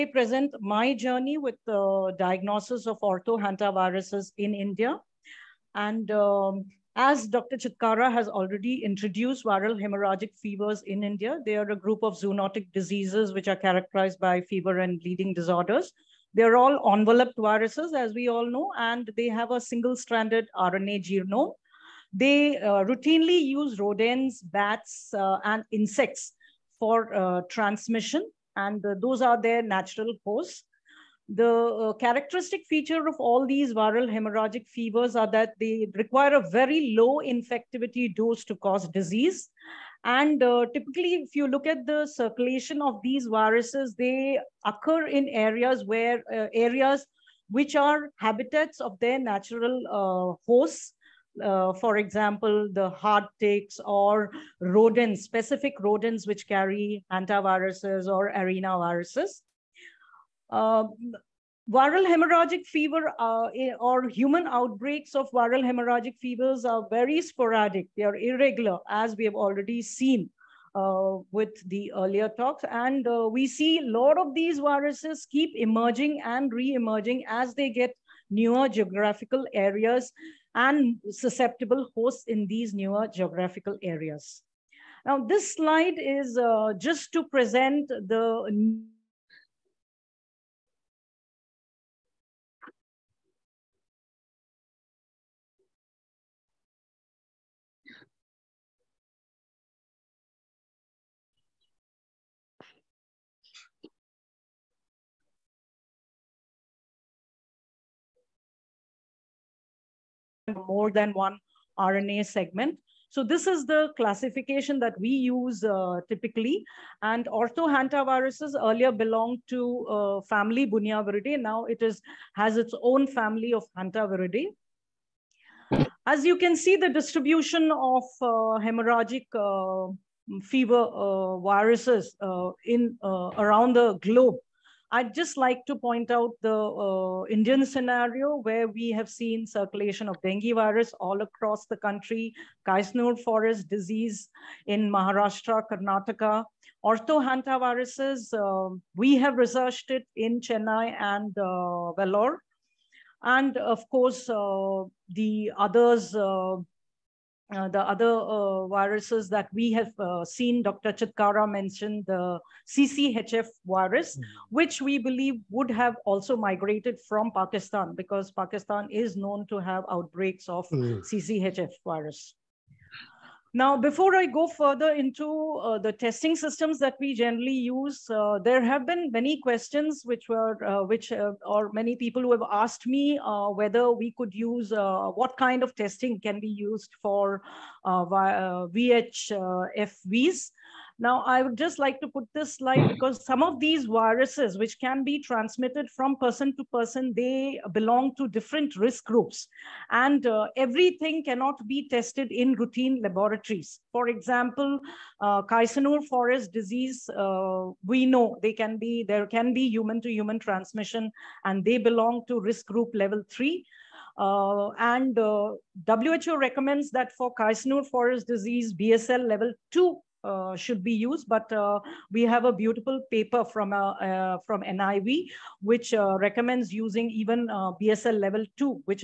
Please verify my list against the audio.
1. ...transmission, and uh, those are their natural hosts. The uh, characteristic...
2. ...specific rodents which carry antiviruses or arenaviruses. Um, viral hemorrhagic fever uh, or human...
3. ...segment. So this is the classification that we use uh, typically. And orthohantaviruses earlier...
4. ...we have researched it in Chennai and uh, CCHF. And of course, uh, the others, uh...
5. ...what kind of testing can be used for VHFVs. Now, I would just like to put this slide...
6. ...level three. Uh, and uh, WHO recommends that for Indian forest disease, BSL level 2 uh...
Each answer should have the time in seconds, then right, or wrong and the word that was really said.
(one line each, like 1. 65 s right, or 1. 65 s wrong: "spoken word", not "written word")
1. 27 s right
2. 55 s right
3. 112 s right
4. 148 s wrong: "Vellore", not "CCHF"
5. 185 s right
6. 212 s wrong: "Kaisenur", not "Indian".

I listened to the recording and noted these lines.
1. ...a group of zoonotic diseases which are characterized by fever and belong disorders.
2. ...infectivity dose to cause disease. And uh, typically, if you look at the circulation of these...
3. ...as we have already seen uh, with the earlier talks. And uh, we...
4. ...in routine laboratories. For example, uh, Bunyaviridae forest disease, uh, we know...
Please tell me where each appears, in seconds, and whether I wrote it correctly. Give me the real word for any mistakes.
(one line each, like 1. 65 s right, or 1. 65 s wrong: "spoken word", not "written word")
1. 11 s wrong: "bleeding", not "belong"
2. 37 s right
3. 68 s right
4. 202 s wrong: "Kaisenur", not "Bunyaviridae".